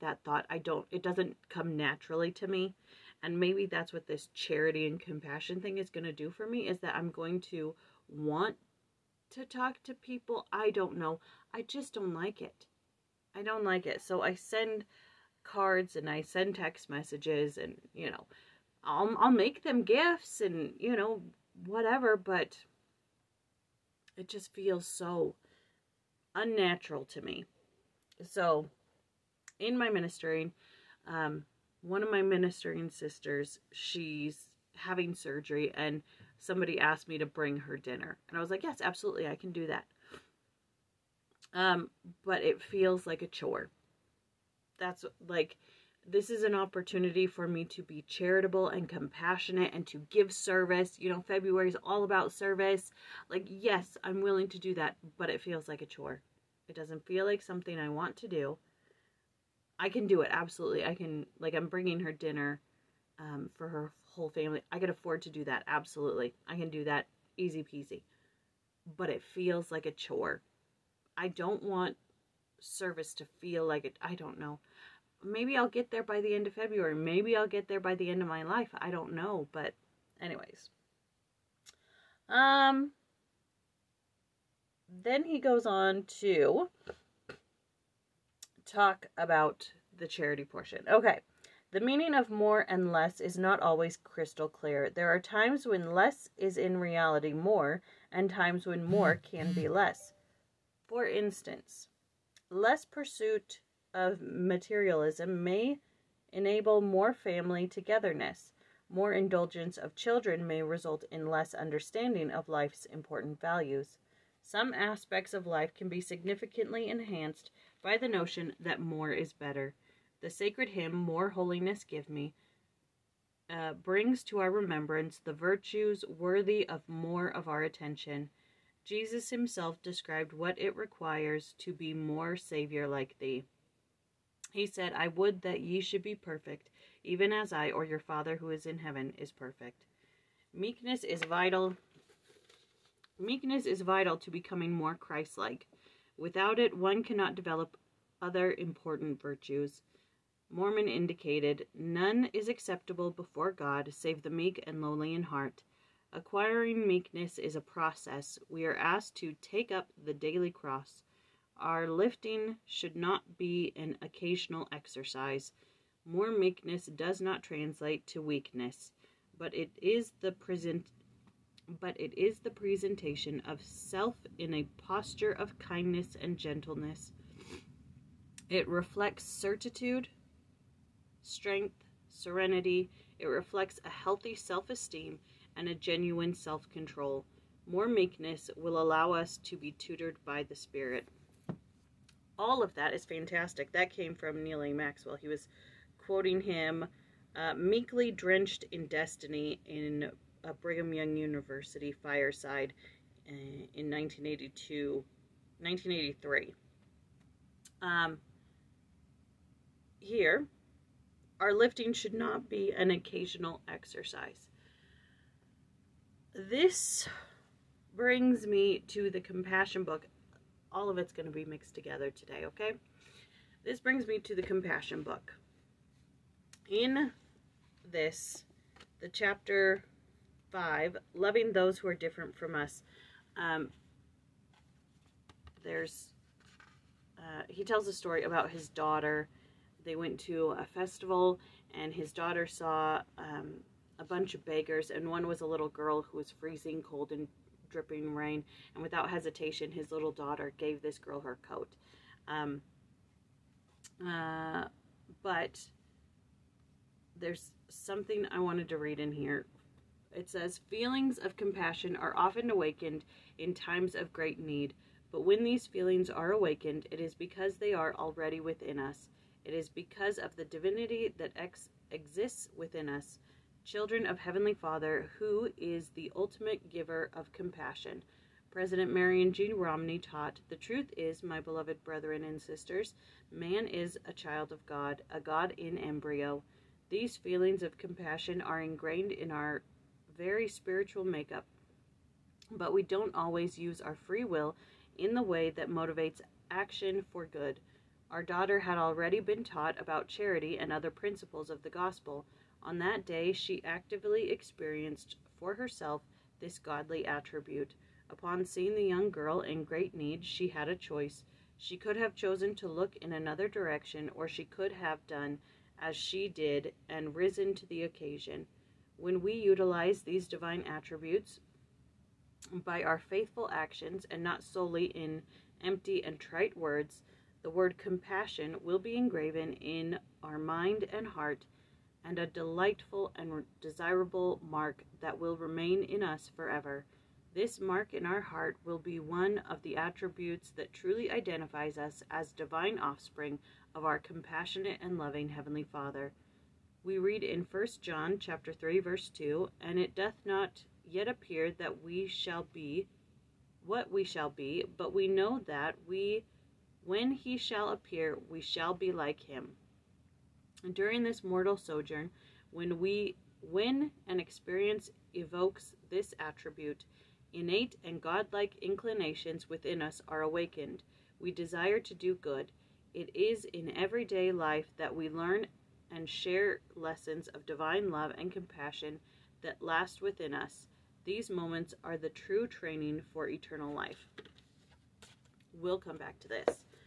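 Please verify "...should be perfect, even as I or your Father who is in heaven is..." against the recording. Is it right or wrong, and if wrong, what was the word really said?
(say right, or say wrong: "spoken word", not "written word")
right.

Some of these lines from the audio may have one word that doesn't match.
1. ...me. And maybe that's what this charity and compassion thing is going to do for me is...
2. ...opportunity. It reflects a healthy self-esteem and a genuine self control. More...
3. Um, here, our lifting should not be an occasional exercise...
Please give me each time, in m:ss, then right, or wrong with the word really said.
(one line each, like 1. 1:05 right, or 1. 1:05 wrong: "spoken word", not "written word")
1. 0:02 right
2. 3:02 wrong: "serenity", not "opportunity"
3. 3:27 right.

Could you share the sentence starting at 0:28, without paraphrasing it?
So, in my ministering, um, one of my ministering sisters, she's having surgery, and somebody asked me to bring her dinner.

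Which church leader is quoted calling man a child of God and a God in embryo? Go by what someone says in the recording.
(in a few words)
Marion G. Romney.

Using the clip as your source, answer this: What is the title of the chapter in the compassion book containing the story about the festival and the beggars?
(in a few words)
Loving Those Who Are Different From Us.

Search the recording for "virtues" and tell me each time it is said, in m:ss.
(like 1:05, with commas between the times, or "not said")
2:05, 2:29.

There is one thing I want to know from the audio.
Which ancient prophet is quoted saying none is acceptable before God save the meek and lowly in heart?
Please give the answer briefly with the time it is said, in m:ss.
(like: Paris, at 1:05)
Mormon, at 2:30.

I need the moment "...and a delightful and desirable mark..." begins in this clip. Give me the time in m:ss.
5:32.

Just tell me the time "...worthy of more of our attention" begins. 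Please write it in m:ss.
2:06.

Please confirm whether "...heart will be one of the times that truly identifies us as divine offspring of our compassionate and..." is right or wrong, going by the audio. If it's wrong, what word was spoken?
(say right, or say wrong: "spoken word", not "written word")
wrong: "attributes", not "times".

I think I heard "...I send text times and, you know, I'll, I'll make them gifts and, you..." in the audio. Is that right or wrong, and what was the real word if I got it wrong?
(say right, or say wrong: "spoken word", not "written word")
wrong: "messages", not "times".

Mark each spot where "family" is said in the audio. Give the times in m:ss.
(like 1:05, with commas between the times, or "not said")
1:04, 1:47.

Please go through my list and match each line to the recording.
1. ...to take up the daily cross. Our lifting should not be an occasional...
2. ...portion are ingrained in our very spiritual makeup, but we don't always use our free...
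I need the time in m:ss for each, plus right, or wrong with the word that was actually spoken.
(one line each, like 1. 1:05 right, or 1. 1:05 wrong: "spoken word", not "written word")
1. 2:39 right
2. 4:47 wrong: "compassion", not "portion".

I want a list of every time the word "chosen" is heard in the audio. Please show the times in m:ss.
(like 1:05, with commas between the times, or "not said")
5:12.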